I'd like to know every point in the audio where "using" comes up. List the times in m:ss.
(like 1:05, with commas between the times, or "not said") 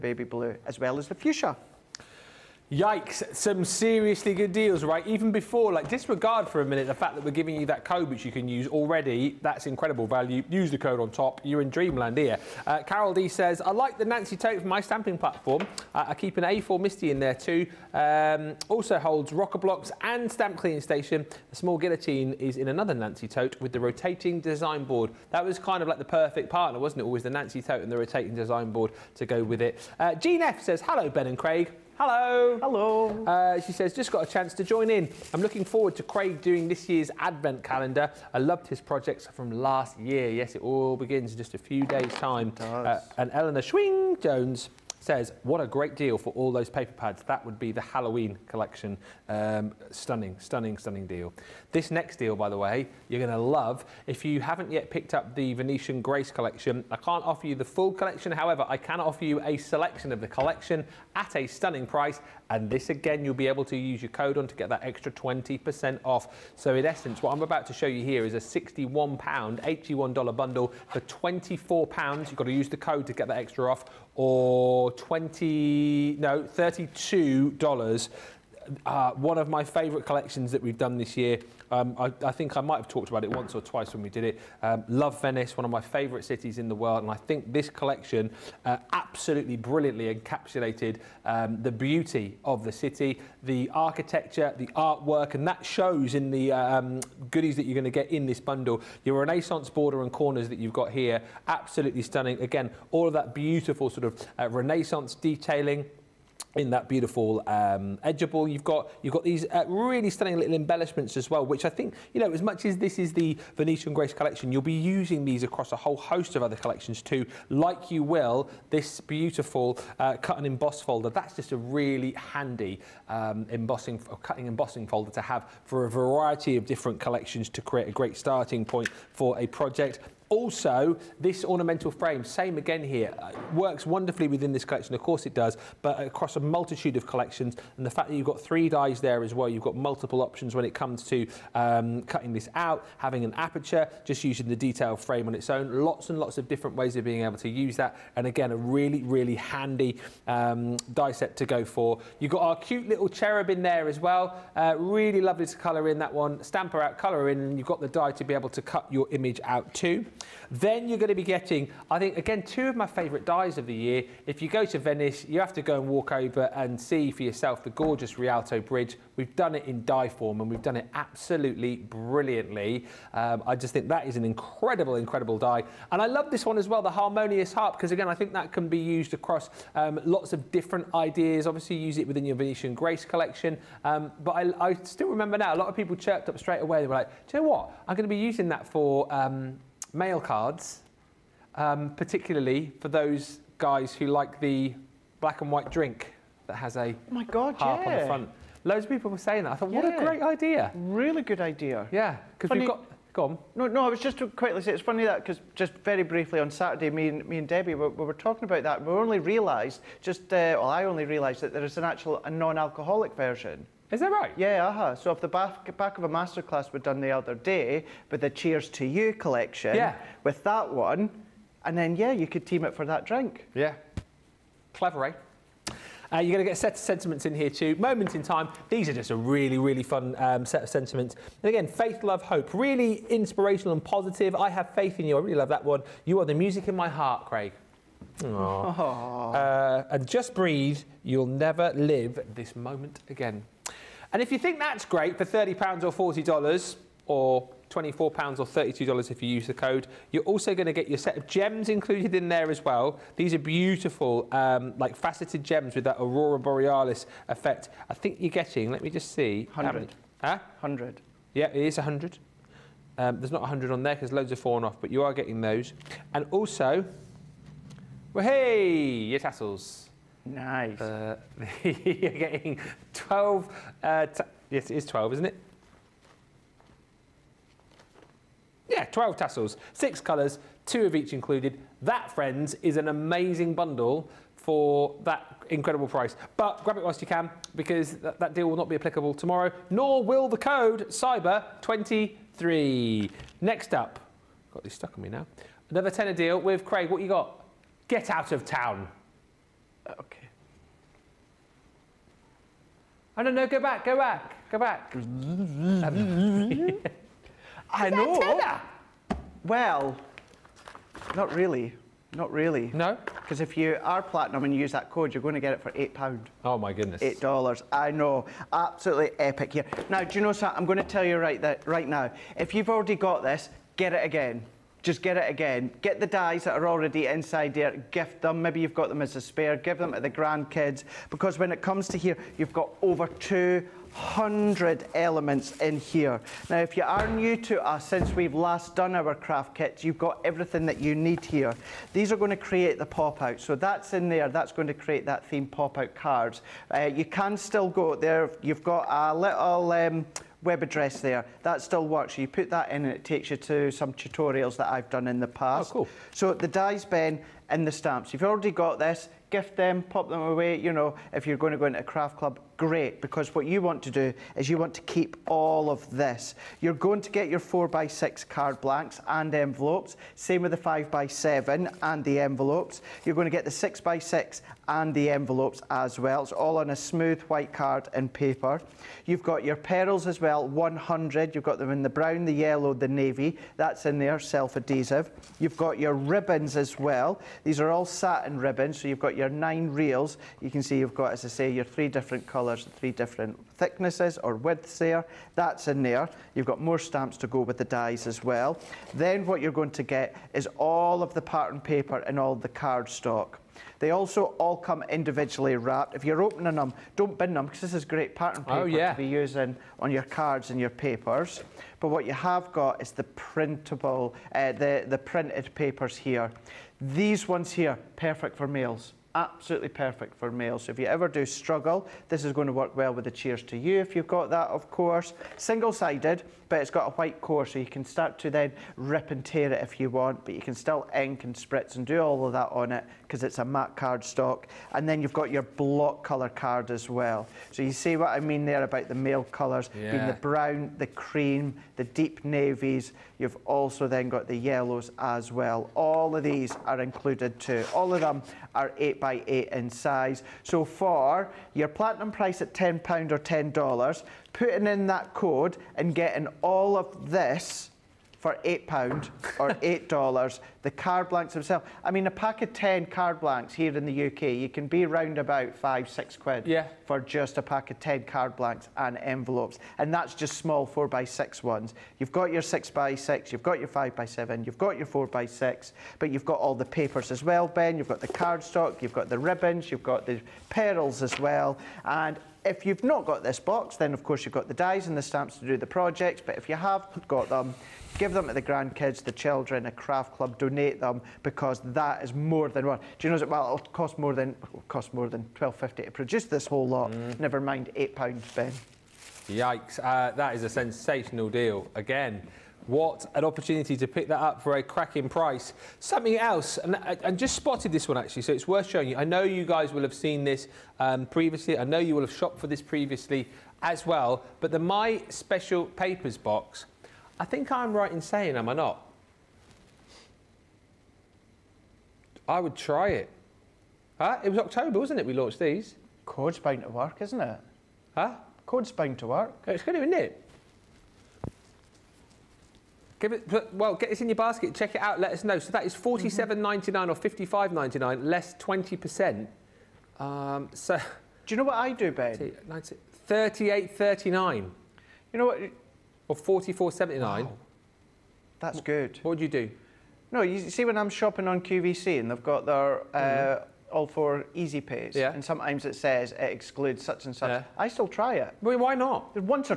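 1:54, 2:24, 3:08, 6:49.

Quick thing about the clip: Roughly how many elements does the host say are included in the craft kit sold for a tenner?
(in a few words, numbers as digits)
over 200.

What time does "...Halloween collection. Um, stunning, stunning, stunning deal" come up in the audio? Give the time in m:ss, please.
0:47.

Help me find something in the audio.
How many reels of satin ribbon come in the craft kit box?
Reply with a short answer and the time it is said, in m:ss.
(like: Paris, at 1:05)
9, at 6:29.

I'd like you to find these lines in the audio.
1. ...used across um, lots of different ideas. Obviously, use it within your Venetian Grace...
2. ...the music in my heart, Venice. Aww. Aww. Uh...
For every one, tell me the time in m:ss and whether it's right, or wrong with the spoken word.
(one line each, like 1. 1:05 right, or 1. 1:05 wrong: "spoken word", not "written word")
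1. 2:58 right
2. 3:56 wrong: "Craig", not "Venice".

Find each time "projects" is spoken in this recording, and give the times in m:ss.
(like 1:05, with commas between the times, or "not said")
0:38, 2:09, 8:05.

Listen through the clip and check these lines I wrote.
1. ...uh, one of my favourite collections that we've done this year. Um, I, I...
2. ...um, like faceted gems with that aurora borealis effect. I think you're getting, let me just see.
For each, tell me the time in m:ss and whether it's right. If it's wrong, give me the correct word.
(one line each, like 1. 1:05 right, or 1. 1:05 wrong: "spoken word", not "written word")
1. 1:18 right
2. 4:14 right.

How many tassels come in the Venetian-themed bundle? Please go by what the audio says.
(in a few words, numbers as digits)
12.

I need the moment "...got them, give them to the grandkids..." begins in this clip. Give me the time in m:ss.
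8:07.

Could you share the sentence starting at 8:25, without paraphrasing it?
Something else, and just spotted this one actually, so it's worth showing you.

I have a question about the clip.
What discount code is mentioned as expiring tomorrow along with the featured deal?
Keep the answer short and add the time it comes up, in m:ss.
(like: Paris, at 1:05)
CYBER23, at 4:50.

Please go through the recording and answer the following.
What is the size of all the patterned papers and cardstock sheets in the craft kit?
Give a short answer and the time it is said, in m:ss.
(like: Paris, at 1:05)
8 by 8, at 7:28.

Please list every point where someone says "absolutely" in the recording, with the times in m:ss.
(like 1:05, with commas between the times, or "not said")
1:28, 1:41, 2:50, 5:18, 6:59.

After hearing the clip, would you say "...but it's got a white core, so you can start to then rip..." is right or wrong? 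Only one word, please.
right.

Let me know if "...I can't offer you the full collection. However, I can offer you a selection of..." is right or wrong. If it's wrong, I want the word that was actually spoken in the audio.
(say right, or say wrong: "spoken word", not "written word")
right.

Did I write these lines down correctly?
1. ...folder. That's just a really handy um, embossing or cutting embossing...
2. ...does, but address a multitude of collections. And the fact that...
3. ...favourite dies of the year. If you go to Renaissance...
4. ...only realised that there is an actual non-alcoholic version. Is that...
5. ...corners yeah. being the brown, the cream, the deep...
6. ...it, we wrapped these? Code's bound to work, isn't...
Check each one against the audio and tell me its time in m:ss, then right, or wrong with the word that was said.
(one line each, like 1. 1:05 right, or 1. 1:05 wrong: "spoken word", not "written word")
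1. 2:00 right
2. 2:15 wrong: "across", not "address"
3. 2:42 wrong: "Venice", not "Renaissance"
4. 3:30 right
5. 7:19 wrong: "colours", not "corners"
6. 8:44 wrong: "launched", not "wrapped".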